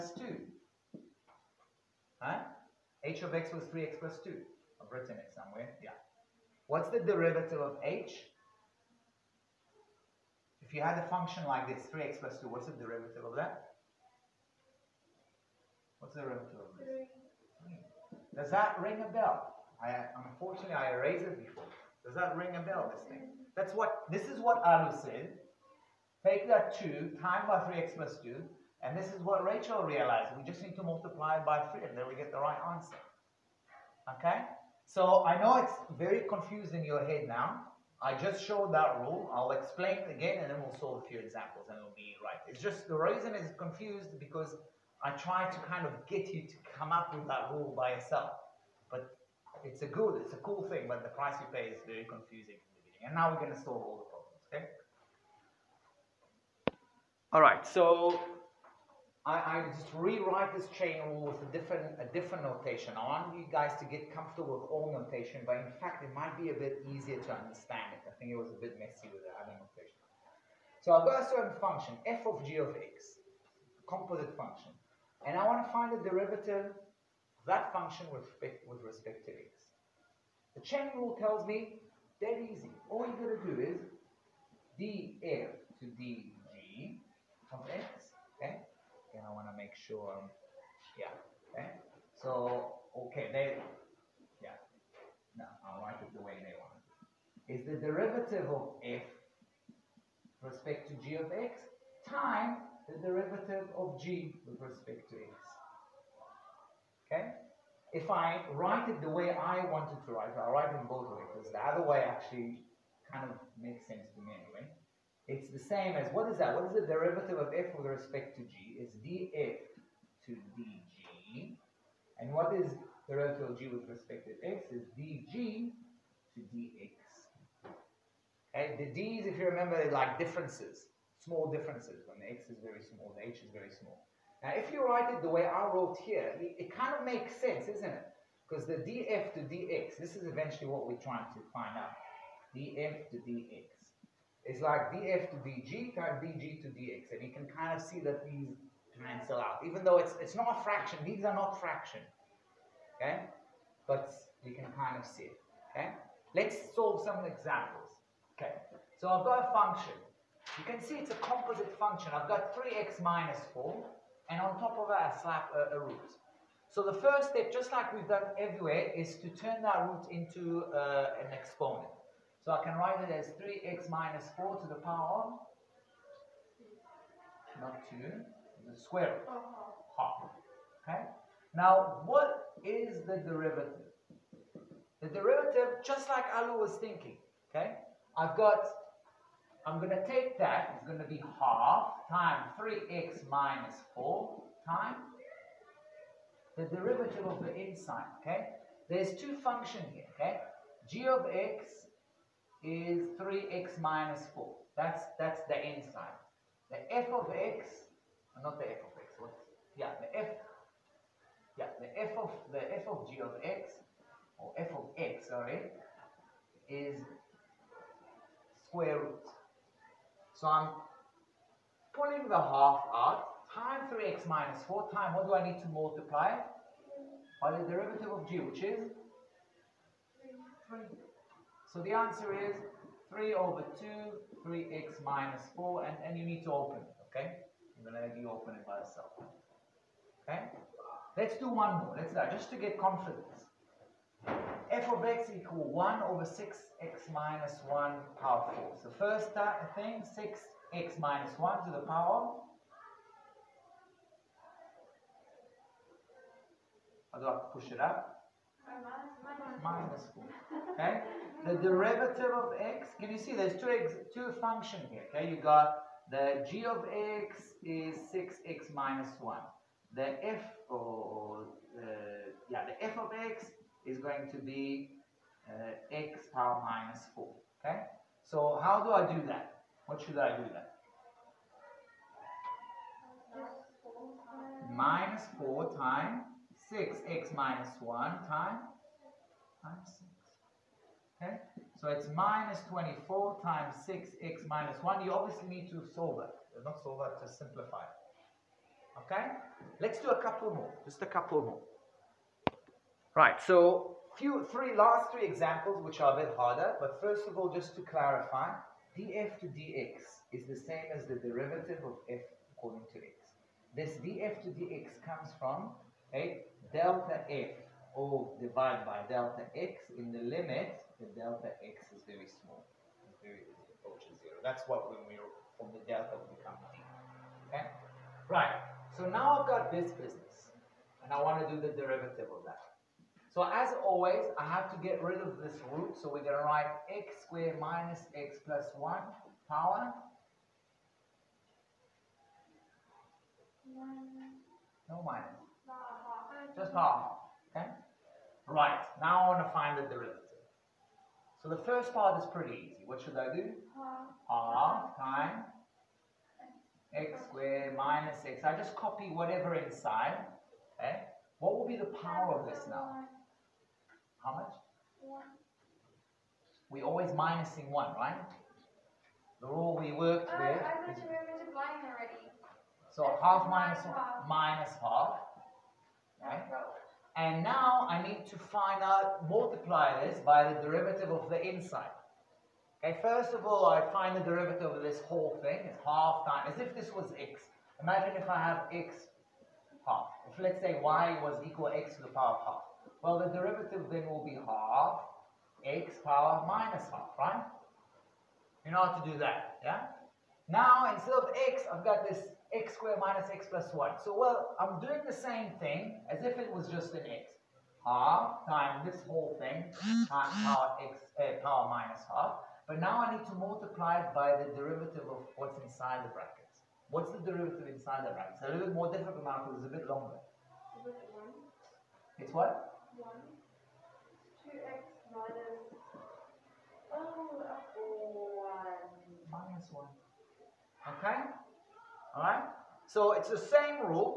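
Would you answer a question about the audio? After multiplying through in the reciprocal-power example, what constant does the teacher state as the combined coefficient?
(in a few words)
-24.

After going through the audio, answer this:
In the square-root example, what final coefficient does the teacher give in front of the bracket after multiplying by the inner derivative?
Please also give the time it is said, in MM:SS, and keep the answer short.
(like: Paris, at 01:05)
3/2, at 03:53.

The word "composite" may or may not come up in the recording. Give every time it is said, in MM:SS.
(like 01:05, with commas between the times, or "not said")
01:13, 02:41.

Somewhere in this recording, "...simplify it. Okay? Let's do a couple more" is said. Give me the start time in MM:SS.
04:57.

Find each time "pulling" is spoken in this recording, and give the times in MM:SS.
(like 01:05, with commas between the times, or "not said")
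03:41.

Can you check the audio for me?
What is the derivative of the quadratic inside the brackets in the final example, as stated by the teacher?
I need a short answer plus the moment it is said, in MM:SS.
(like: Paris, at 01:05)
2x - 1, at 07:04.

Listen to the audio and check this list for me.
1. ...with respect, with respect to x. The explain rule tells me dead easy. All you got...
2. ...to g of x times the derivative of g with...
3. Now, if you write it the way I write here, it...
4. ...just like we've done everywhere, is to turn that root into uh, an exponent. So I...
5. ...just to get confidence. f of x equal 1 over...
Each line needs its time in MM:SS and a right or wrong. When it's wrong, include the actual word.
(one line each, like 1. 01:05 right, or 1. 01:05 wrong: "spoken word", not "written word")
1. 01:18 wrong: "chain", not "explain"
2. 01:40 right
3. 02:14 wrong: "wrote", not "write"
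4. 02:47 right
5. 04:02 right.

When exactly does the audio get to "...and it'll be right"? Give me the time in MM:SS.
00:41.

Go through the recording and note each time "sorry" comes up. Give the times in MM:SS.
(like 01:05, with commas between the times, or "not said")
03:35.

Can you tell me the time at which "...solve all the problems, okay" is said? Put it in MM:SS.
00:53.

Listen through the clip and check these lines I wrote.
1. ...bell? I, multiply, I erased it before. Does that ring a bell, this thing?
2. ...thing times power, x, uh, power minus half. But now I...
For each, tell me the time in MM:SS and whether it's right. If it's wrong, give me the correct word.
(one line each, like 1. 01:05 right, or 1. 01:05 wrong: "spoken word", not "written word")
1. 00:19 wrong: "unfortunately", not "multiply"
2. 06:49 right.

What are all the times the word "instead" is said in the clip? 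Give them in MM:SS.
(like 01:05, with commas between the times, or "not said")
06:40.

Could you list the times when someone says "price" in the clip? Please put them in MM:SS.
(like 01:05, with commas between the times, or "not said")
00:51.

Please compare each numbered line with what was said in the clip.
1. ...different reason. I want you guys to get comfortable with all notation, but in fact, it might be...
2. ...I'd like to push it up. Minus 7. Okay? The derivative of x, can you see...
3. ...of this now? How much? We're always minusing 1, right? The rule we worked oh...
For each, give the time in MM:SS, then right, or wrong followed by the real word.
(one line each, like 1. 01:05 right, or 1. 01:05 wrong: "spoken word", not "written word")
1. 01:02 wrong: "notation", not "reason"
2. 04:17 wrong: "4", not "7"
3. 06:02 right.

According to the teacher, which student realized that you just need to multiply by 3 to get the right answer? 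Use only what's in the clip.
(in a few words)
Rachel.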